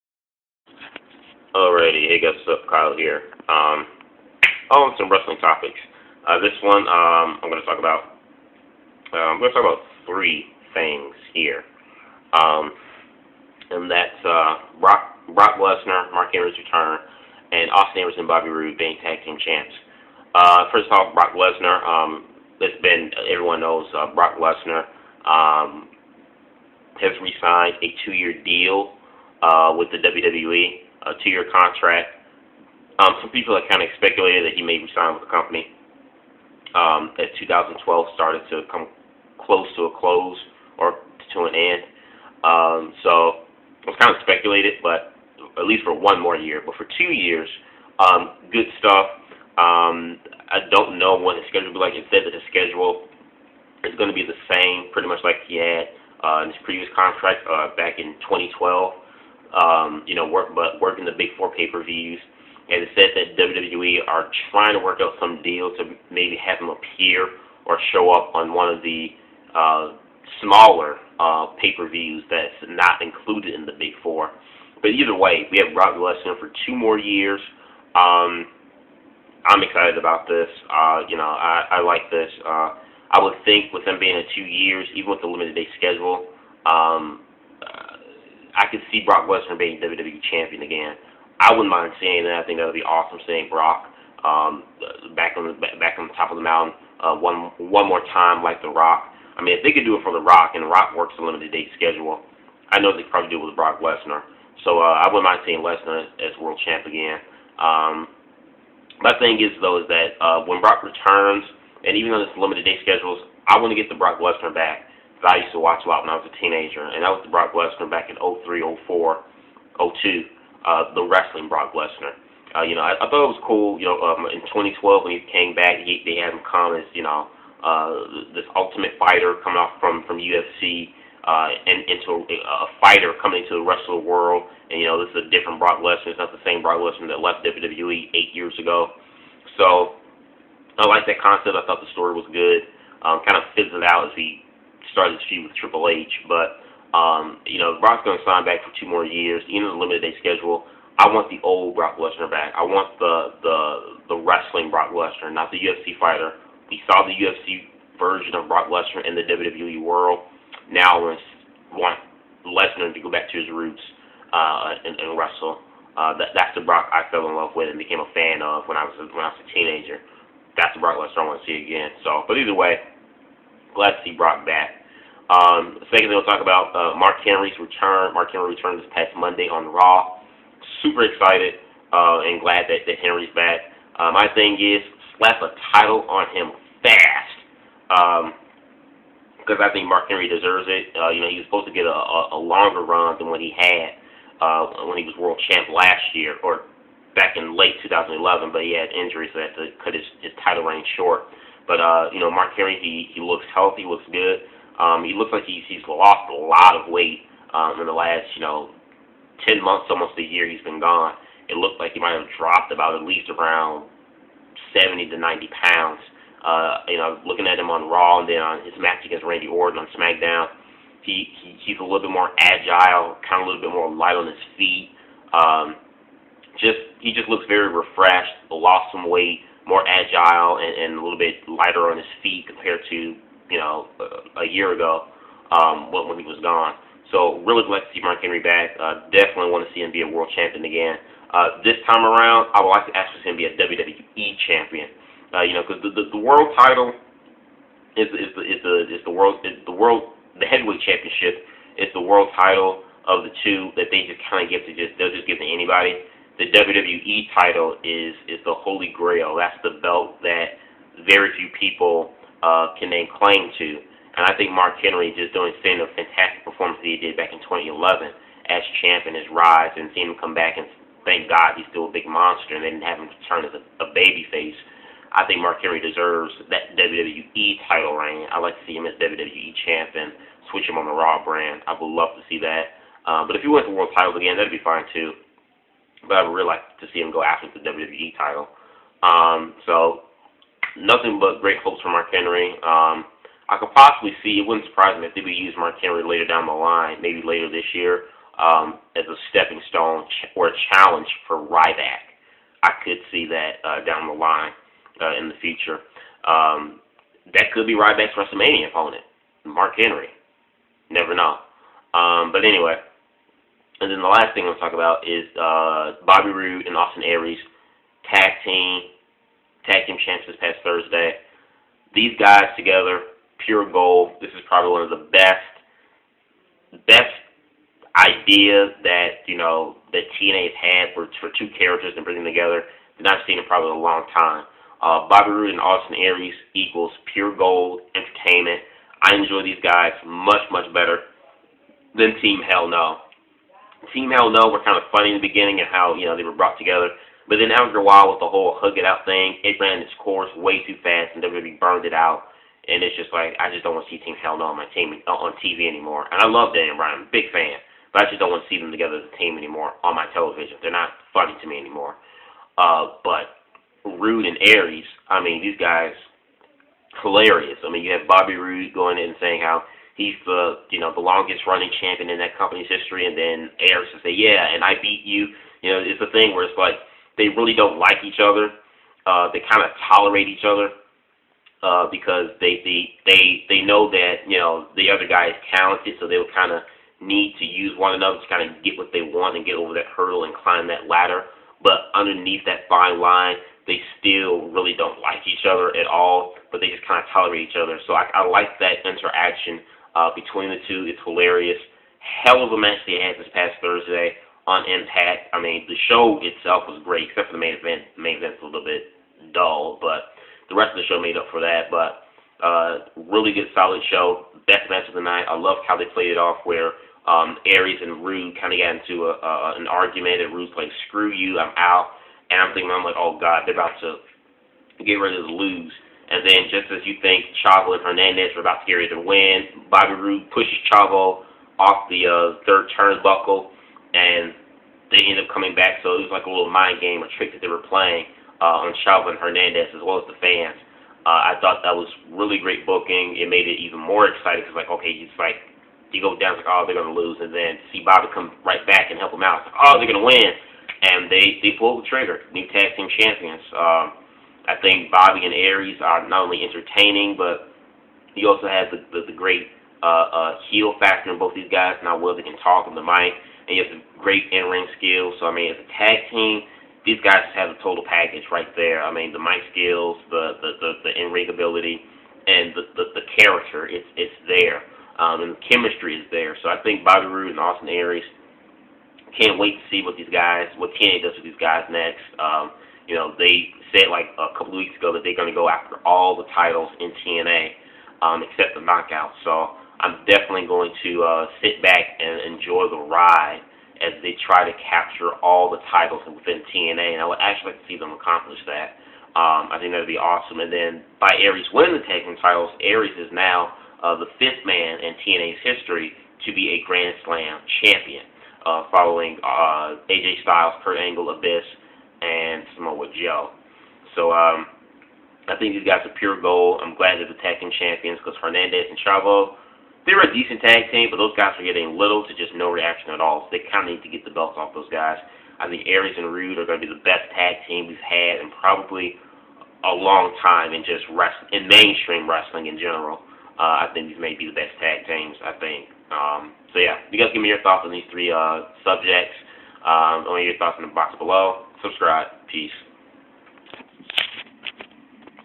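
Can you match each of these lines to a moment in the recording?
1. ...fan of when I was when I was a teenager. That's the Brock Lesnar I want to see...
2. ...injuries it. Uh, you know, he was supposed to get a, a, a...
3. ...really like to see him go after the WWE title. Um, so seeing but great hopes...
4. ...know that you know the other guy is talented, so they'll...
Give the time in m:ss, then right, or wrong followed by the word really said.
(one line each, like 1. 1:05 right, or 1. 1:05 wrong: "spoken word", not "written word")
1. 2:48 right
2. 3:10 wrong: "deserves", not "injuries"
3. 4:46 wrong: "nothing", not "seeing"
4. 6:23 right.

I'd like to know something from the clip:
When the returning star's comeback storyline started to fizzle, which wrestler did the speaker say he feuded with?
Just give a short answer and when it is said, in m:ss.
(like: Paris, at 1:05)
Triple H, at 2:25.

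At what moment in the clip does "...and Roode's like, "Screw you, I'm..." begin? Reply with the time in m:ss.
7:00.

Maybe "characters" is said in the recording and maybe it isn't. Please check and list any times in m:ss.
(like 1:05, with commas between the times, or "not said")
5:31, 7:53.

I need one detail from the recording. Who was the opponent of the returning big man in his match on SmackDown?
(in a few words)
Randy Orton.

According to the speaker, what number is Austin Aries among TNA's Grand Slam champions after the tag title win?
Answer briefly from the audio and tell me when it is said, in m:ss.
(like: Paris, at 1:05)
5th, at 8:24.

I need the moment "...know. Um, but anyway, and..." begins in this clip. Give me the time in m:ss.
5:11.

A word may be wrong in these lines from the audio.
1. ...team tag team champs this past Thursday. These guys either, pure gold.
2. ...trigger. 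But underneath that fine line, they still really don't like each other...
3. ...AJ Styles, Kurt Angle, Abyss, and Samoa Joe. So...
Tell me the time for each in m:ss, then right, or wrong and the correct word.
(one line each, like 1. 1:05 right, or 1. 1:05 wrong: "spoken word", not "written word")
1. 5:18 wrong: "together", not "either"
2. 6:30 wrong: "ladder", not "trigger"
3. 8:29 right.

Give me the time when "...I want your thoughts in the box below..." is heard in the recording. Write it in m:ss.
9:00.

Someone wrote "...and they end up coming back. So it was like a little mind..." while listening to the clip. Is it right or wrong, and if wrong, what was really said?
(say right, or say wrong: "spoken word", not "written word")
right.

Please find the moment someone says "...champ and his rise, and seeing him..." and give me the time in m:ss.
4:28.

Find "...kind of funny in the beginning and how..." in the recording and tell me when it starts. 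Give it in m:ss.
5:44.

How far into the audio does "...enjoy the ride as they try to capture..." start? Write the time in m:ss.
8:12.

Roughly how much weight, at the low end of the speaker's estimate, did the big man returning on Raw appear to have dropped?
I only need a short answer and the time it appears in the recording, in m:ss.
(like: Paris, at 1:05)
70 pounds, at 3:34.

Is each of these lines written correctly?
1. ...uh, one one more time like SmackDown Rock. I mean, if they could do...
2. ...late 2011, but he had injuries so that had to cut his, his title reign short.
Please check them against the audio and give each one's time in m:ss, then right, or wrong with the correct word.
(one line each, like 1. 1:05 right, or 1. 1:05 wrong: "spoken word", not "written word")
1. 1:37 wrong: "The", not "SmackDown"
2. 3:17 right.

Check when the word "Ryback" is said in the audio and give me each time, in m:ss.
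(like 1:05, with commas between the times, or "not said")
5:01, 5:07.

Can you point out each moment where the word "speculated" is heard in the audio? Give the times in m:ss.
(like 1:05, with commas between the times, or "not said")
0:33, 0:44.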